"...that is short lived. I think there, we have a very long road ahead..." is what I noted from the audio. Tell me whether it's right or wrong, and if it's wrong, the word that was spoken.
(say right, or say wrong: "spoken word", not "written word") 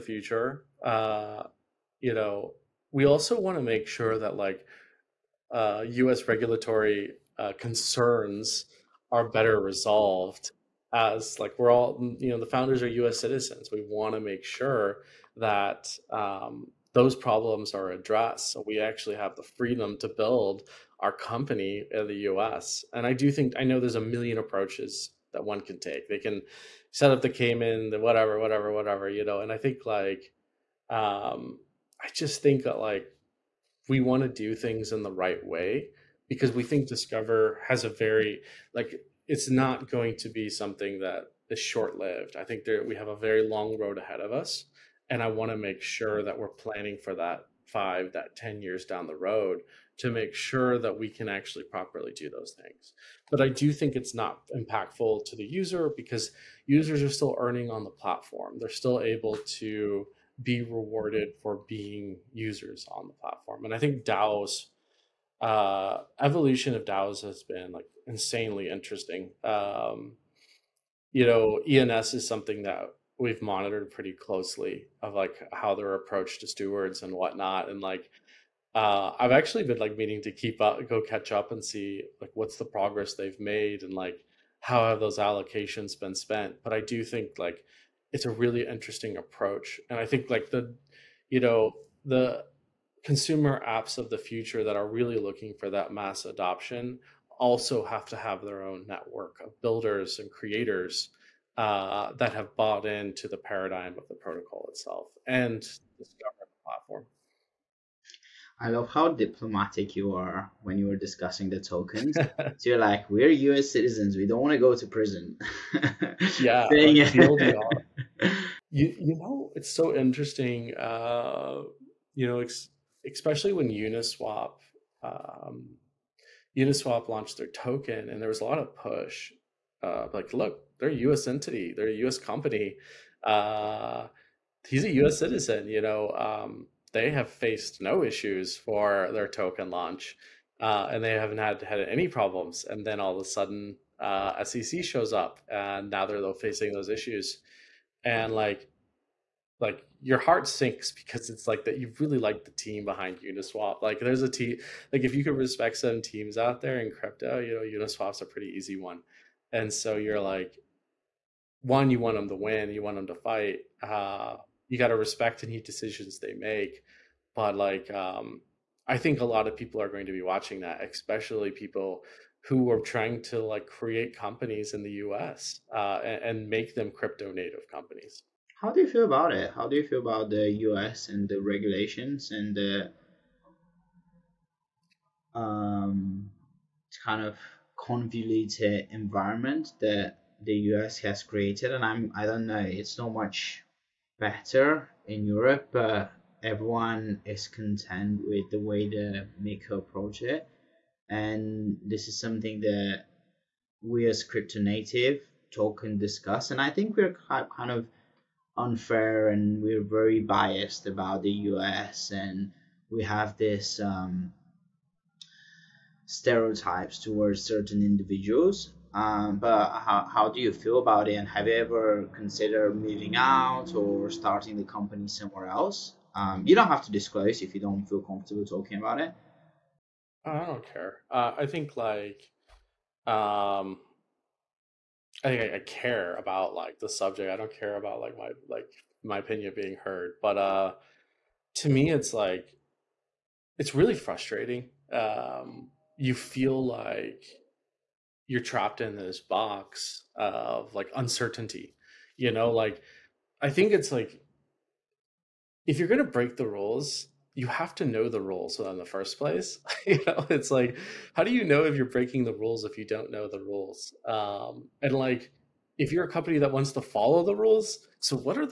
right.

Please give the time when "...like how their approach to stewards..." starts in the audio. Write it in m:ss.
1:15.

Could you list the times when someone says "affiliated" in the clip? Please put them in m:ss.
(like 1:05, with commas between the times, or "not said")
not said.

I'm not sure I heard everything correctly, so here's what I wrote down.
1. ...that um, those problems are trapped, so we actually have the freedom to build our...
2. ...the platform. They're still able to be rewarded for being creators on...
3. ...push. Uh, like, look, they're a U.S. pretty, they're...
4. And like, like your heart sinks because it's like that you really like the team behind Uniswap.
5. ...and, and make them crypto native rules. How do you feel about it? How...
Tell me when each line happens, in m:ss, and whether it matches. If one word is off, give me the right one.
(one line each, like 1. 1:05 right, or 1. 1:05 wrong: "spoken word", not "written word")
1. 0:15 wrong: "addressed", not "trapped"
2. 0:57 wrong: "users", not "creators"
3. 2:08 wrong: "entity", not "pretty"
4. 2:28 right
5. 2:56 wrong: "companies", not "rules".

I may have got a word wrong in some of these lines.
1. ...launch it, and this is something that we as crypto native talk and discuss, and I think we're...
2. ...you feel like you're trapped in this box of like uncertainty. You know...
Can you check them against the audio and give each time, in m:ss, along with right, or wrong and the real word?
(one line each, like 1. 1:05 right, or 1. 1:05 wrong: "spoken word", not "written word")
1. 3:19 wrong: "approach", not "launch"
2. 4:05 right.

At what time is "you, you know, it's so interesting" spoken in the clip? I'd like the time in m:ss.
1:58.